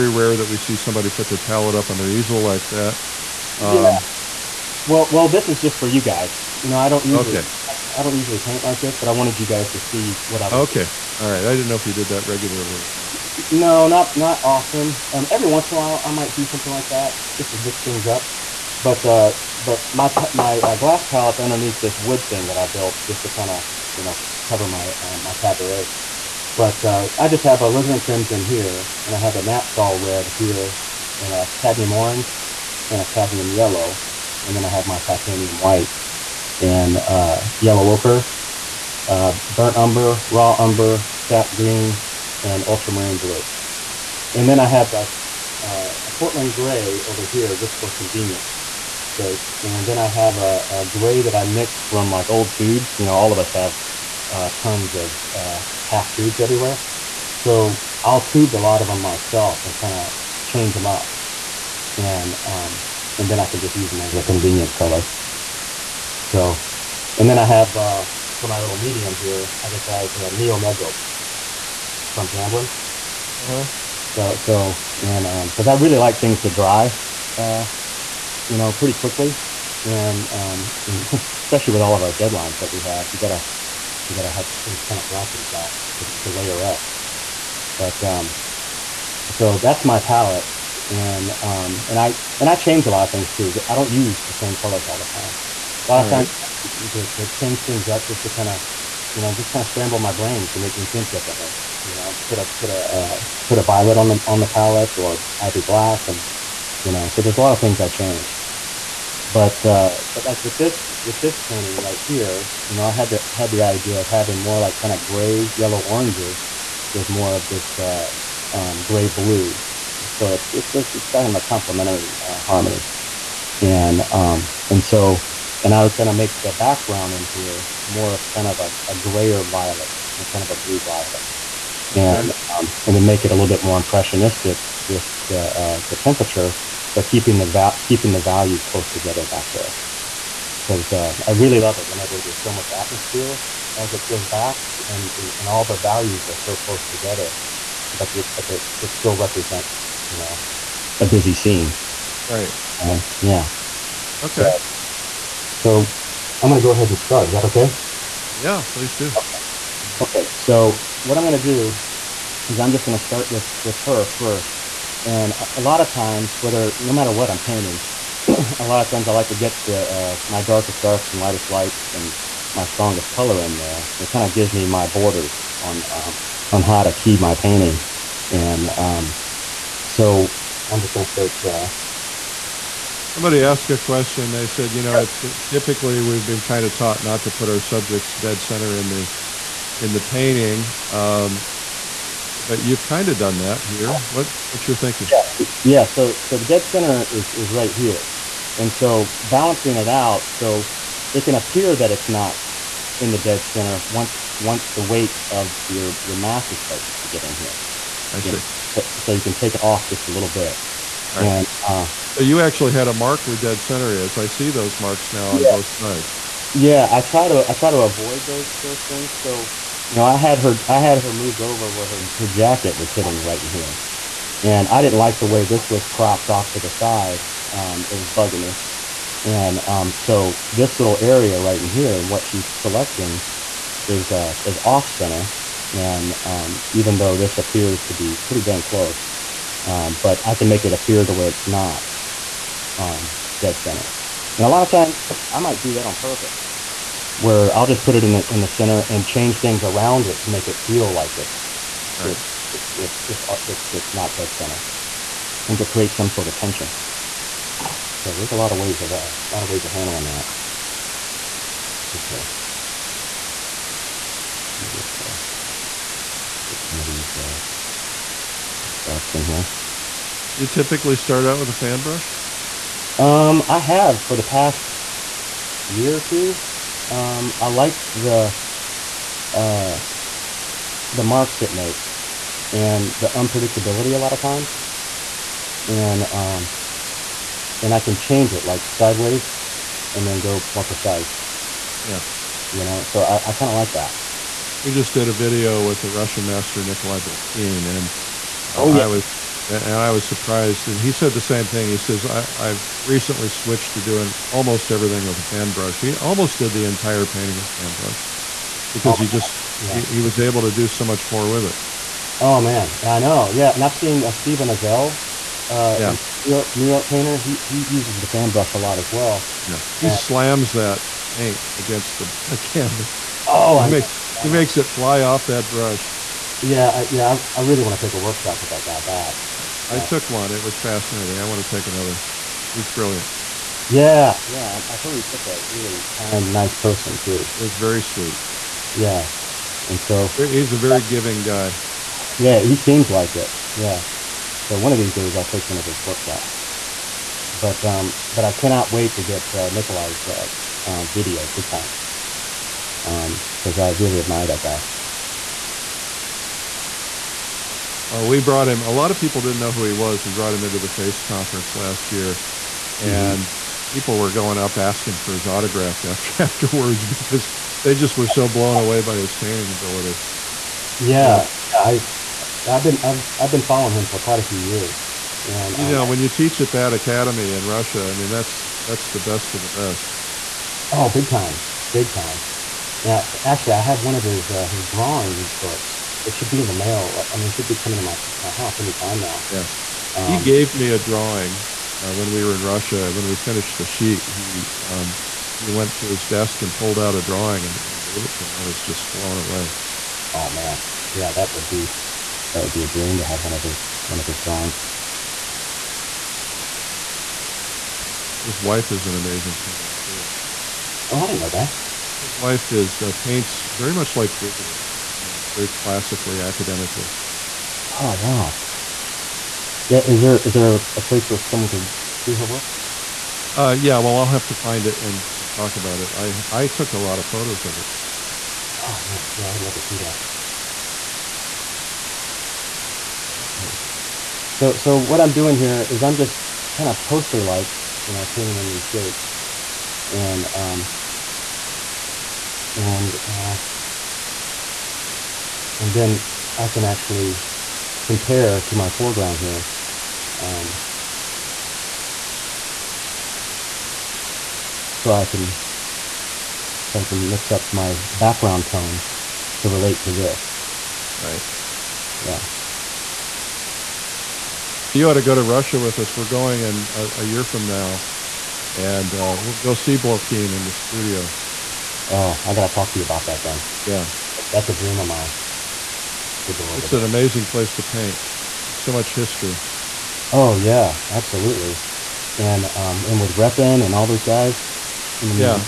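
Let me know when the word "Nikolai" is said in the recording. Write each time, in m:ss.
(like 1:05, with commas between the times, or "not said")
4:56, 5:49.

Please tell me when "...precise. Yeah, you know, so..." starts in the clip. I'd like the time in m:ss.
4:50.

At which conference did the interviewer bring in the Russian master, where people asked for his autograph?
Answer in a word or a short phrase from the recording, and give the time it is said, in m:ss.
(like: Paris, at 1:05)
FACE conference, at 6:00.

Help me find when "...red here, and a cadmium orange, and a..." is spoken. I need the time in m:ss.
0:30.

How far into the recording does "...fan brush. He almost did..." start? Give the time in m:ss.
5:05.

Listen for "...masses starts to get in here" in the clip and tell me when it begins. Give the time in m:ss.
3:26.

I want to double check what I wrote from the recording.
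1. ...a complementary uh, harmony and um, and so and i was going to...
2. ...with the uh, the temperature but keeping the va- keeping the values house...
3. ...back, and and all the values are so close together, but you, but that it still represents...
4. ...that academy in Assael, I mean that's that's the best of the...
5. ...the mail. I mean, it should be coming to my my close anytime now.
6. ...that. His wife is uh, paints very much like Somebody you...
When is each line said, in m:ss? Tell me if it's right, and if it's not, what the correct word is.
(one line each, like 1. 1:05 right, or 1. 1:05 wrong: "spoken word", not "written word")
1. 2:01 right
2. 2:14 wrong: "close", not "house"
3. 2:24 right
4. 6:16 wrong: "Russia", not "Assael"
5. 6:26 wrong: "house", not "close"
6. 6:51 wrong: "Bouguereau", not "Somebody".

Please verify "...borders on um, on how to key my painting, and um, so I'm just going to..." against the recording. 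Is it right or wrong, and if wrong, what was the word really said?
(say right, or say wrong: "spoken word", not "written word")
right.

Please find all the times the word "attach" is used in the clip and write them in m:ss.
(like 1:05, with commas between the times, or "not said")
not said.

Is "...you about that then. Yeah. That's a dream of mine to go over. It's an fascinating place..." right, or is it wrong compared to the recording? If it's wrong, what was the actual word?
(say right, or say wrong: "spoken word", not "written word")
wrong: "amazing", not "fascinating".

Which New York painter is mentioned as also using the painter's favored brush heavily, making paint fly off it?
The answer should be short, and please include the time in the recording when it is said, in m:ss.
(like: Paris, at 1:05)
Steven Assael, at 5:14.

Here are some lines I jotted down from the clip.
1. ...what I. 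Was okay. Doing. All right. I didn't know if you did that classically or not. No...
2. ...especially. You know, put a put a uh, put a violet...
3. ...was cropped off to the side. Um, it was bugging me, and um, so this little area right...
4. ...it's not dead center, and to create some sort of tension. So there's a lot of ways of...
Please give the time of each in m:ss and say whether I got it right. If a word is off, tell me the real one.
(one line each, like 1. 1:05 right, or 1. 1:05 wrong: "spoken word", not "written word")
1. 0:10 wrong: "regularly", not "classically"
2. 1:41 wrong: "differently", not "especially"
3. 3:45 right
4. 4:13 right.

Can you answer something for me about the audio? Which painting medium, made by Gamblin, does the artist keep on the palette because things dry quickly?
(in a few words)
Neo Megilp.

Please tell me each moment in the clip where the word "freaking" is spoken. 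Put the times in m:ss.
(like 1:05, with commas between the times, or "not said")
not said.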